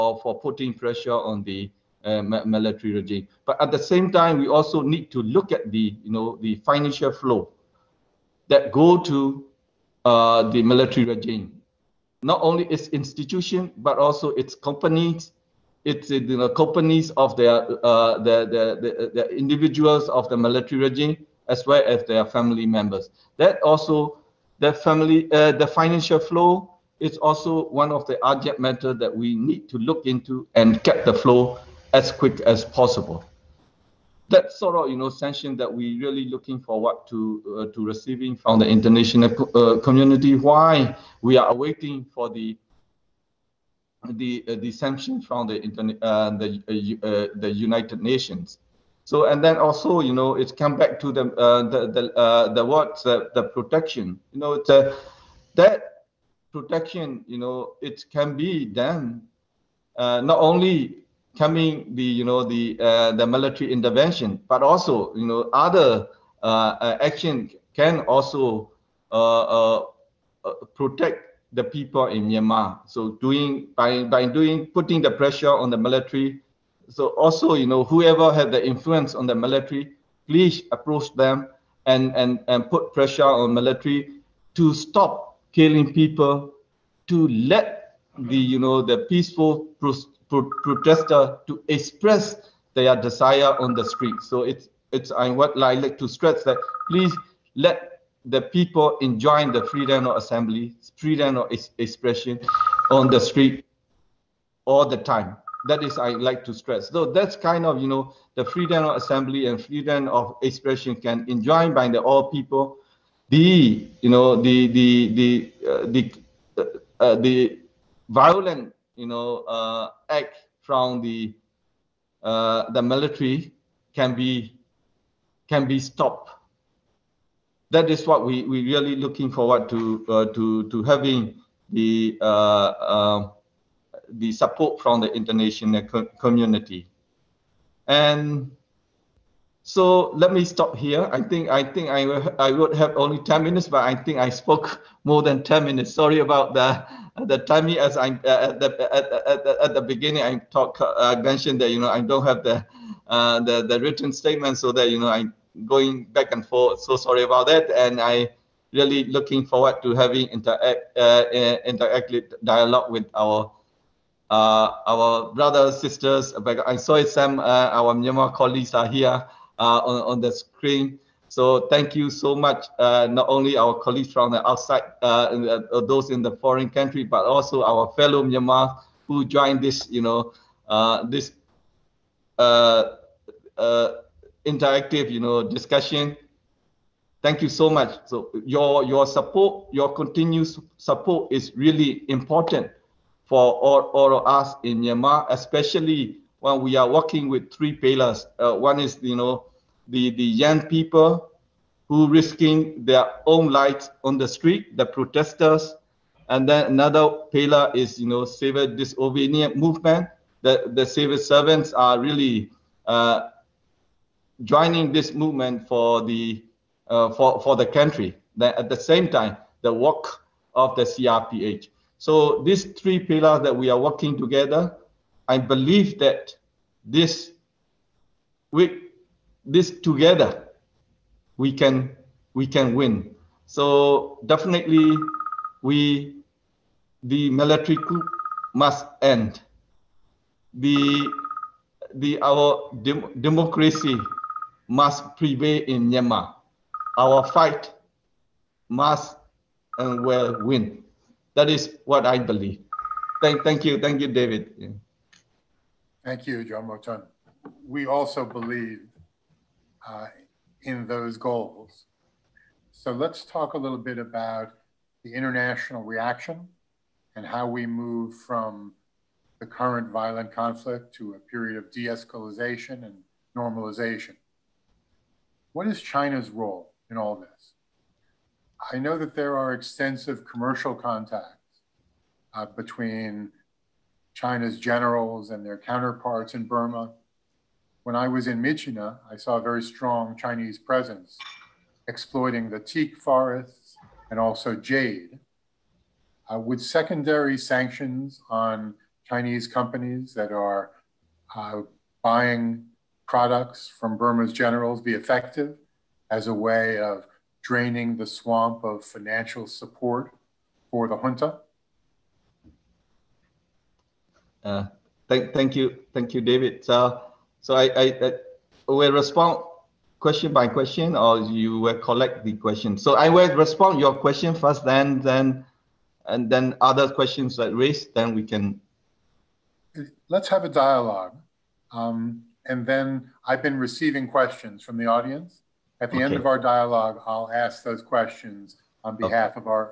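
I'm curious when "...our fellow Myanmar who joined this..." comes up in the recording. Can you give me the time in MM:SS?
02:57.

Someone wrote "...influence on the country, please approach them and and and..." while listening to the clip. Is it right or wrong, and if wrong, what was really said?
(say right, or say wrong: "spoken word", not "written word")
wrong: "military", not "country".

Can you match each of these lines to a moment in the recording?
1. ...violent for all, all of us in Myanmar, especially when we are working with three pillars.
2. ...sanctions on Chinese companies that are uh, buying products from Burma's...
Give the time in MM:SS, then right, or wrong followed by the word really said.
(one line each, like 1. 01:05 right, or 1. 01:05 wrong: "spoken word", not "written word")
1. 03:12 wrong: "important", not "violent"
2. 04:57 right.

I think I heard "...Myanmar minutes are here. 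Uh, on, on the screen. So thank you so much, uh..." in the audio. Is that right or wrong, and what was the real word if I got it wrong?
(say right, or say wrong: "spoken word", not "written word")
wrong: "colleagues", not "minutes".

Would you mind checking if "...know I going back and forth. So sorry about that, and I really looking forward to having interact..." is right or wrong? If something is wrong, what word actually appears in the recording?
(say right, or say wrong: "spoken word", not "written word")
right.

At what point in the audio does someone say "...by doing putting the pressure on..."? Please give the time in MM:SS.
01:14.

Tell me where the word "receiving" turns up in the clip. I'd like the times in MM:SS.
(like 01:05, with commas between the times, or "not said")
00:37, 05:33.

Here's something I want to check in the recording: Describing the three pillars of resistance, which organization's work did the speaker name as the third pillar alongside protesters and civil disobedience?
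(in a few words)
CRPH.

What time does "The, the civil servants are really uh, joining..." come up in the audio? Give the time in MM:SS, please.
03:30.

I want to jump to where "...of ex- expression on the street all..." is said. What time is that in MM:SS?
01:41.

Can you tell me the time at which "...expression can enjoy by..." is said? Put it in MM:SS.
01:50.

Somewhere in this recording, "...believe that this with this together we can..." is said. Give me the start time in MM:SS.
03:45.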